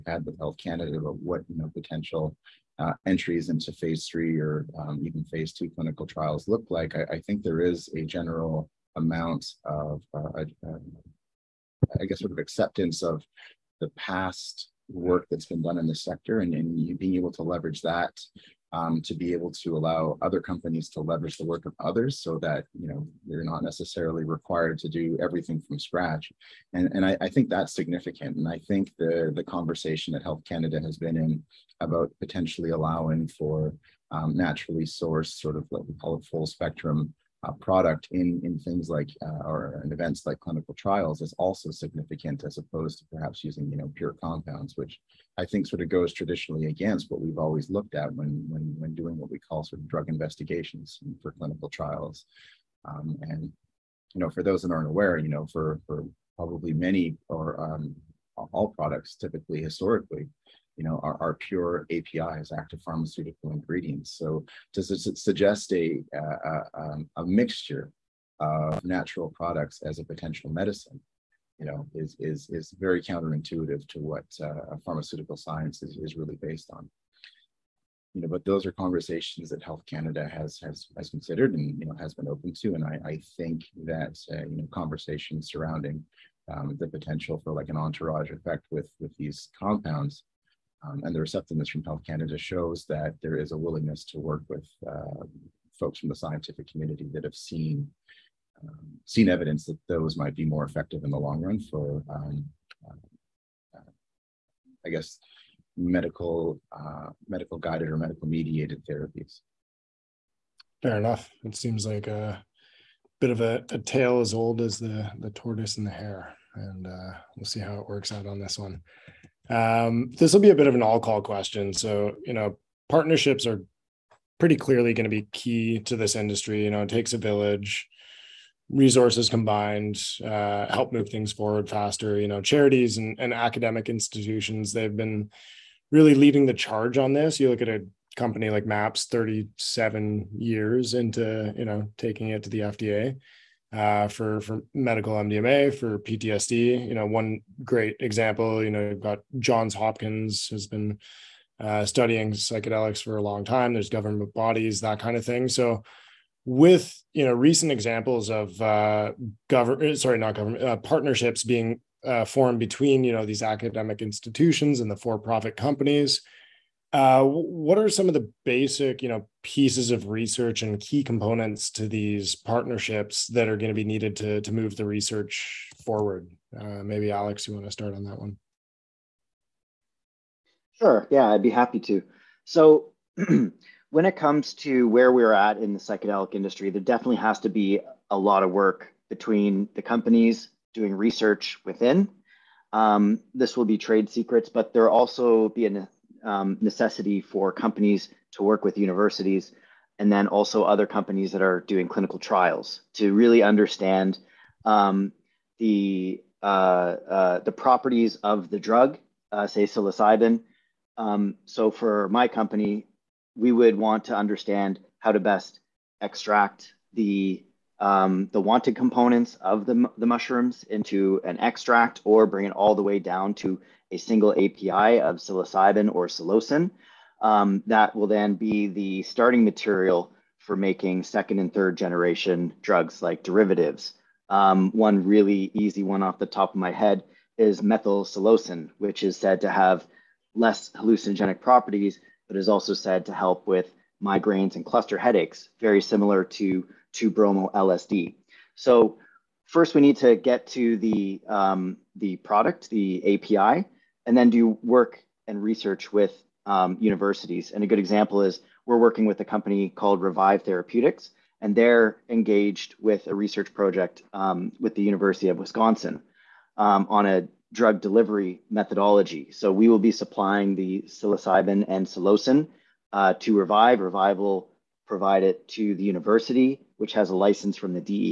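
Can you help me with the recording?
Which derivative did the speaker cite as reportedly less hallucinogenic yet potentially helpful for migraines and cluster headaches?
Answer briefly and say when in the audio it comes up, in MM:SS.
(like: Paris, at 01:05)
methyl psilocin, at 03:57.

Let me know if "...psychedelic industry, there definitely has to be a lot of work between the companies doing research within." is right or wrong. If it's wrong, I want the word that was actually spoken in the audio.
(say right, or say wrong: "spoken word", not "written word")
right.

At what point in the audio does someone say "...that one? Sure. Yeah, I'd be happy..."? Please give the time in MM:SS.
02:58.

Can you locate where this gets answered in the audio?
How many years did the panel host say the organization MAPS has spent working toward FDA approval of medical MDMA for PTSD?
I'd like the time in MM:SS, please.
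02:19.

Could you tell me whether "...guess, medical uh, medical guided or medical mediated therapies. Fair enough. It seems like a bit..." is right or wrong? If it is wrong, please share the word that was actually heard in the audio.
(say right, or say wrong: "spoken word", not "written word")
right.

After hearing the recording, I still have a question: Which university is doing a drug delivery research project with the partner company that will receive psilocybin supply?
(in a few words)
University of Wisconsin.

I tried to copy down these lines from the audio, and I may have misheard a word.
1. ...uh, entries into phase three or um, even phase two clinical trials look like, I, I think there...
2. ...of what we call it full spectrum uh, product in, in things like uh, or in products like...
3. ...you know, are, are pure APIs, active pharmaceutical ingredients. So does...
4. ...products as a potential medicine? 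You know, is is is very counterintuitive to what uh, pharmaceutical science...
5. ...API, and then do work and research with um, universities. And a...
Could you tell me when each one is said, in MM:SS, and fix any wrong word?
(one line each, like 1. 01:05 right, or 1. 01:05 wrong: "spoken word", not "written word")
1. 00:02 right
2. 00:35 wrong: "events", not "products"
3. 01:00 right
4. 01:09 right
5. 04:13 right.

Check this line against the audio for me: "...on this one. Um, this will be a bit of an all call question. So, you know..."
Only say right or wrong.
right.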